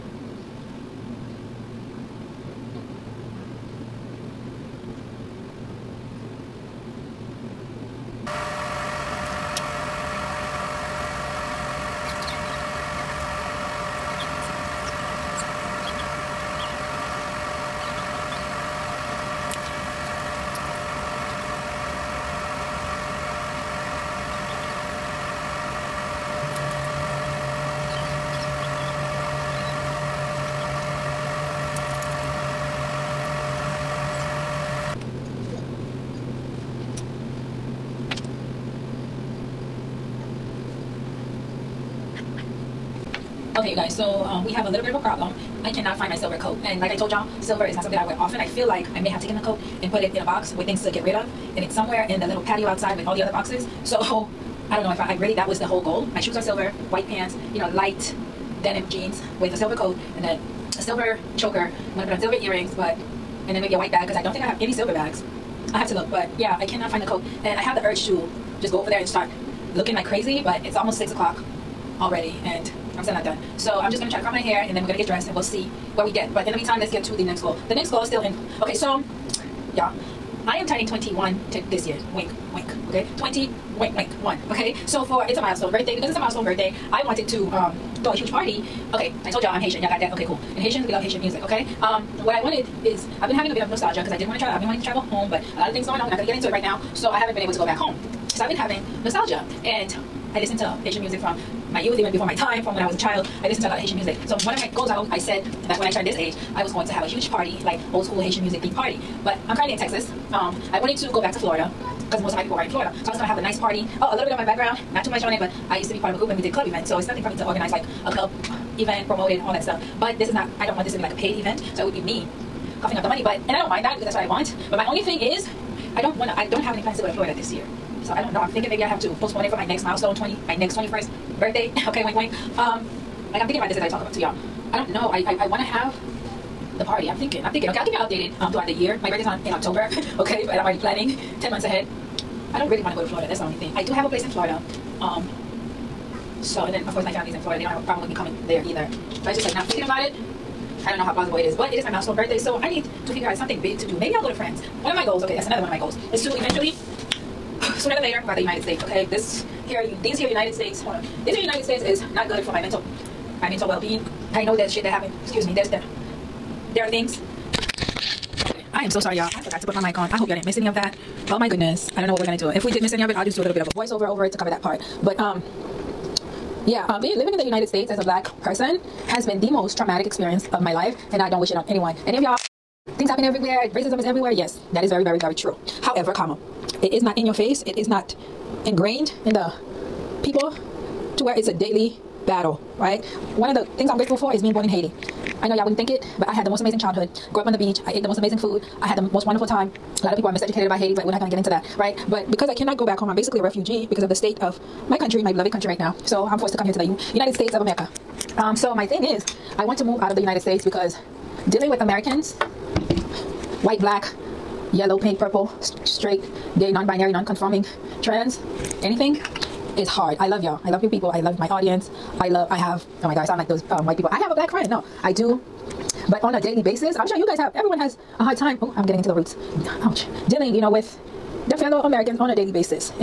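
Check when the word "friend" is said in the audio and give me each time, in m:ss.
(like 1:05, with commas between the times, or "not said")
3:44.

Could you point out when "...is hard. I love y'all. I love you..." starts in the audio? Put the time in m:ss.
3:39.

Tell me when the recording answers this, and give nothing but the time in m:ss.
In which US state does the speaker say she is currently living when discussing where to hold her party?
1:49.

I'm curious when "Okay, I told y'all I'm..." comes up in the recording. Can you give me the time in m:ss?
1:28.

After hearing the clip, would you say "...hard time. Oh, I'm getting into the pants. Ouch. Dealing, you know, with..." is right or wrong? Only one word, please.
wrong.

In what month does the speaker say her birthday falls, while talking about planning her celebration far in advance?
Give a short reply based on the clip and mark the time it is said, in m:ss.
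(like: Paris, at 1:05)
October, at 2:19.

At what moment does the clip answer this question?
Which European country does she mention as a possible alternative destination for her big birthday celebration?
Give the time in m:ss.
2:34.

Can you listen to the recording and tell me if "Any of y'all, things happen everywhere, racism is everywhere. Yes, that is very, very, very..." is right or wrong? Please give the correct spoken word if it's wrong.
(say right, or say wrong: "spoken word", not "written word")
right.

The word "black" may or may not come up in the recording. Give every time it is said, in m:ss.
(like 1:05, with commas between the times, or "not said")
2:58, 3:33, 3:44.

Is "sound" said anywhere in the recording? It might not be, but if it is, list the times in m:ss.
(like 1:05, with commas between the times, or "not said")
3:43.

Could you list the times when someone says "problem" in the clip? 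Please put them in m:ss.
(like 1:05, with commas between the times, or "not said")
0:45, 2:27.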